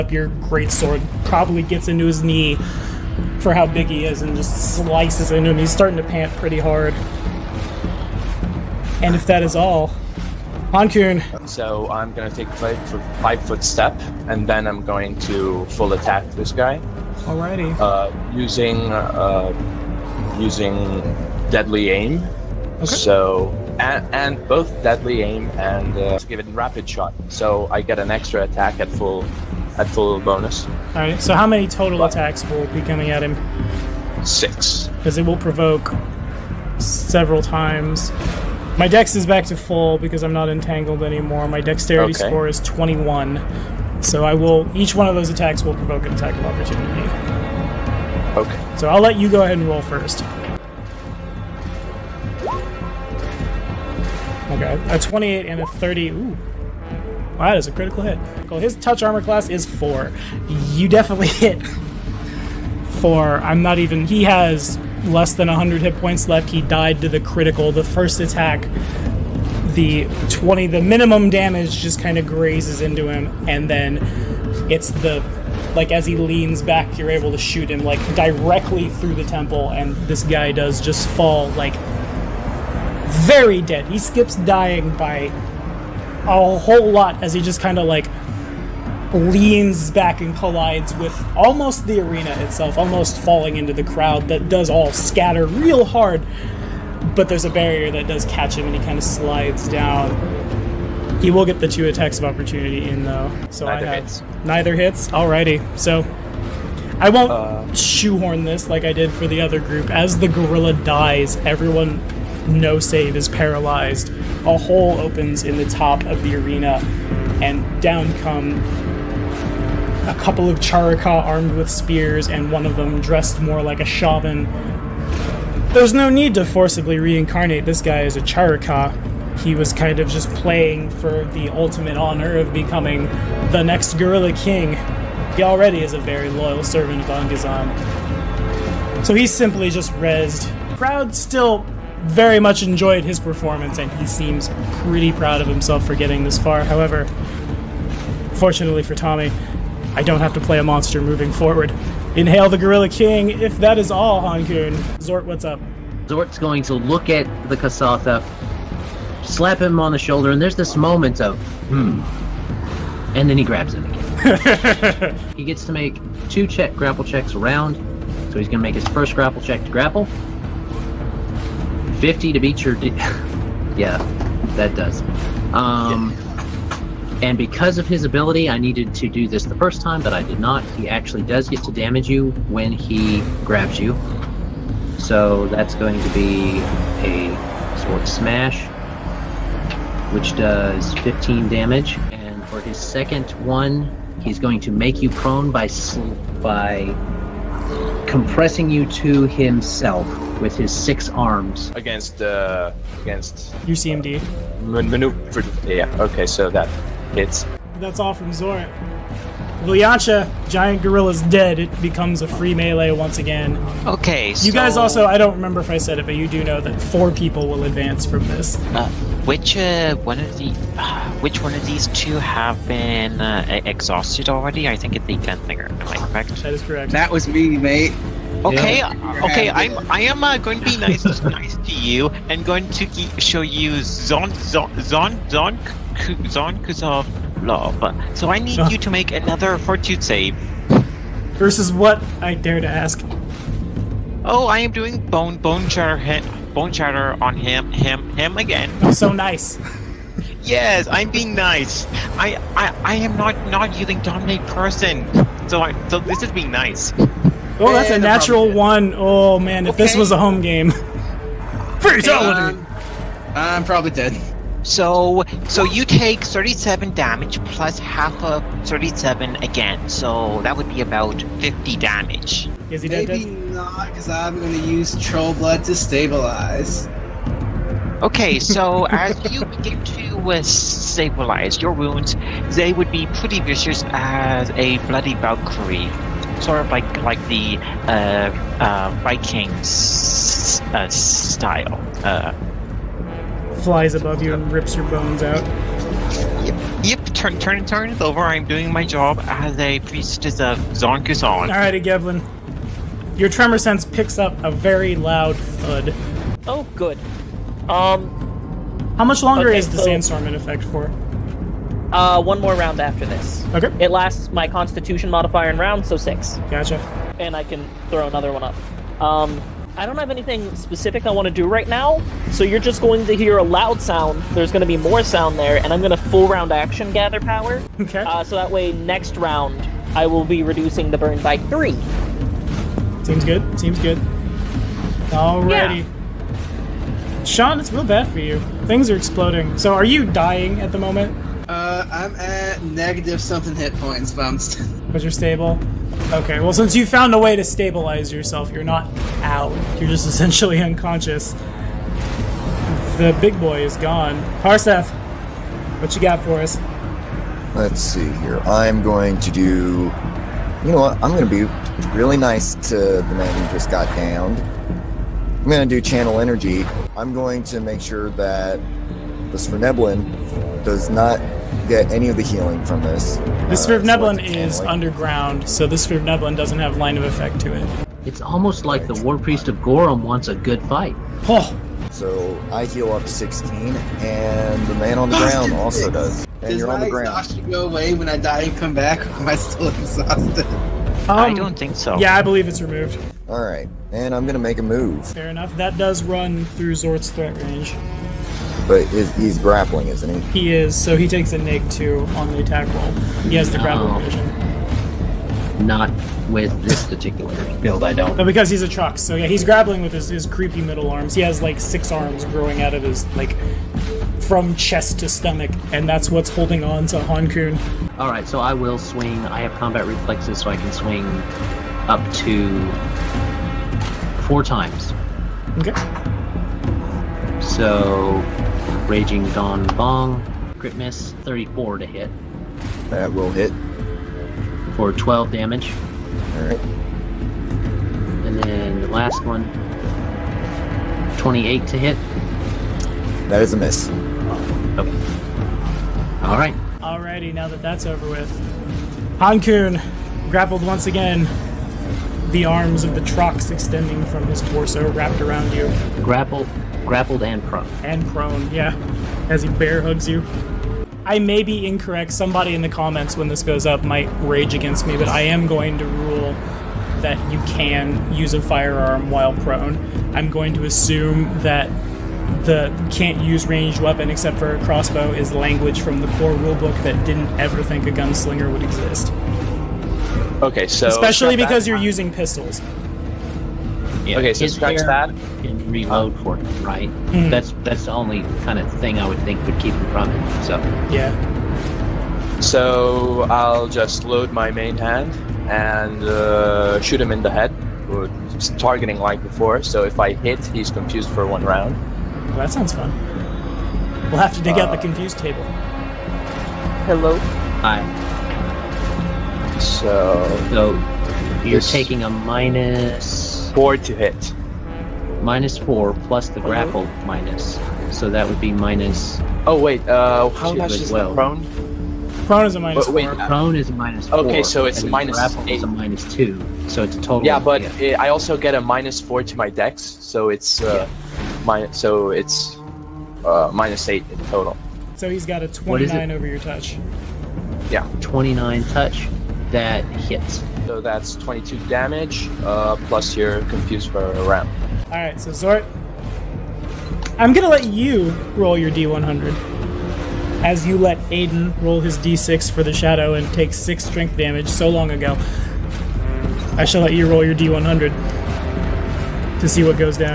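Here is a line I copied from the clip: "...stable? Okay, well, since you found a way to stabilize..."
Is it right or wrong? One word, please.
right.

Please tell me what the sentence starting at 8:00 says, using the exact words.
Okay, so especially because you're using pistols.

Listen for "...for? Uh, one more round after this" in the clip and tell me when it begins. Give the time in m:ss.
5:10.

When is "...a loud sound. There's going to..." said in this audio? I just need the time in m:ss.
5:23.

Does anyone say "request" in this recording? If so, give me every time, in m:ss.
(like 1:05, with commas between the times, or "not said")
not said.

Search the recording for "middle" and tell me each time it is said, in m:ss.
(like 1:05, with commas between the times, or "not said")
6:50.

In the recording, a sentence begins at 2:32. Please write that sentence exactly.
Inhale the Gorilla King, if that is all, Hankun.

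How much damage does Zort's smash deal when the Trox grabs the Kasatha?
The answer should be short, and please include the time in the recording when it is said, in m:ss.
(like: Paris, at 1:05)
15, at 3:11.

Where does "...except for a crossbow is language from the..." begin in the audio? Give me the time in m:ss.
7:54.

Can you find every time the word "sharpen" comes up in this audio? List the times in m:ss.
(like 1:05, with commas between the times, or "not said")
not said.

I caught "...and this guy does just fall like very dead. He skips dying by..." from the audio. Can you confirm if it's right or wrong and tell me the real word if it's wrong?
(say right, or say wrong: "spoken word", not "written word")
right.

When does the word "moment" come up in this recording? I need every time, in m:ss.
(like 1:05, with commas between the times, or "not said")
2:40, 5:40.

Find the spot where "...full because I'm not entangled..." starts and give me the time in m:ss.
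0:39.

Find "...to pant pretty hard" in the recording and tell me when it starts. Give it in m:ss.
0:05.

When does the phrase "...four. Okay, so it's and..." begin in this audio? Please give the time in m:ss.
8:44.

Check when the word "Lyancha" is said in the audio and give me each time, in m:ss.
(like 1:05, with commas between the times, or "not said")
3:29.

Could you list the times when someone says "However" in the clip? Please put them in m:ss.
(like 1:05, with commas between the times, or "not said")
2:26.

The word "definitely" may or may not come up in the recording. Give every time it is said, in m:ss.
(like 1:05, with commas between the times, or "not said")
1:00.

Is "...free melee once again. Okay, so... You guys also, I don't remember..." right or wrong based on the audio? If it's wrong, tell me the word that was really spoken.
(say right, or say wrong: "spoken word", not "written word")
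right.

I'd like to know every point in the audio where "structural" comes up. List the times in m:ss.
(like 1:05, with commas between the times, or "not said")
not said.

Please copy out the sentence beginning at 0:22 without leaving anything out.
So and, and both deadly aim and uh, give it rapid shot.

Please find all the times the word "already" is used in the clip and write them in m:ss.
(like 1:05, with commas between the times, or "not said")
2:15, 3:44.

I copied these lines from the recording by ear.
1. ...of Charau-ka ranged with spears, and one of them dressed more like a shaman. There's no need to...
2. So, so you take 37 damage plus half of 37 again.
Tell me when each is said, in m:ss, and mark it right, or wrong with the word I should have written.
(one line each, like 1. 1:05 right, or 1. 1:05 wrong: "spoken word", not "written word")
1. 2:00 wrong: "armed", not "ranged"
2. 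4:24 right.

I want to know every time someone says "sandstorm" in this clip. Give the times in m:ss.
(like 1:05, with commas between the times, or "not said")
5:09.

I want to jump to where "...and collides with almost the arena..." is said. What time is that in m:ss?
1:30.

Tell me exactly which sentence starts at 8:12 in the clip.
So I'll just load my main hand and uh, shoot him in the head, targeting like before.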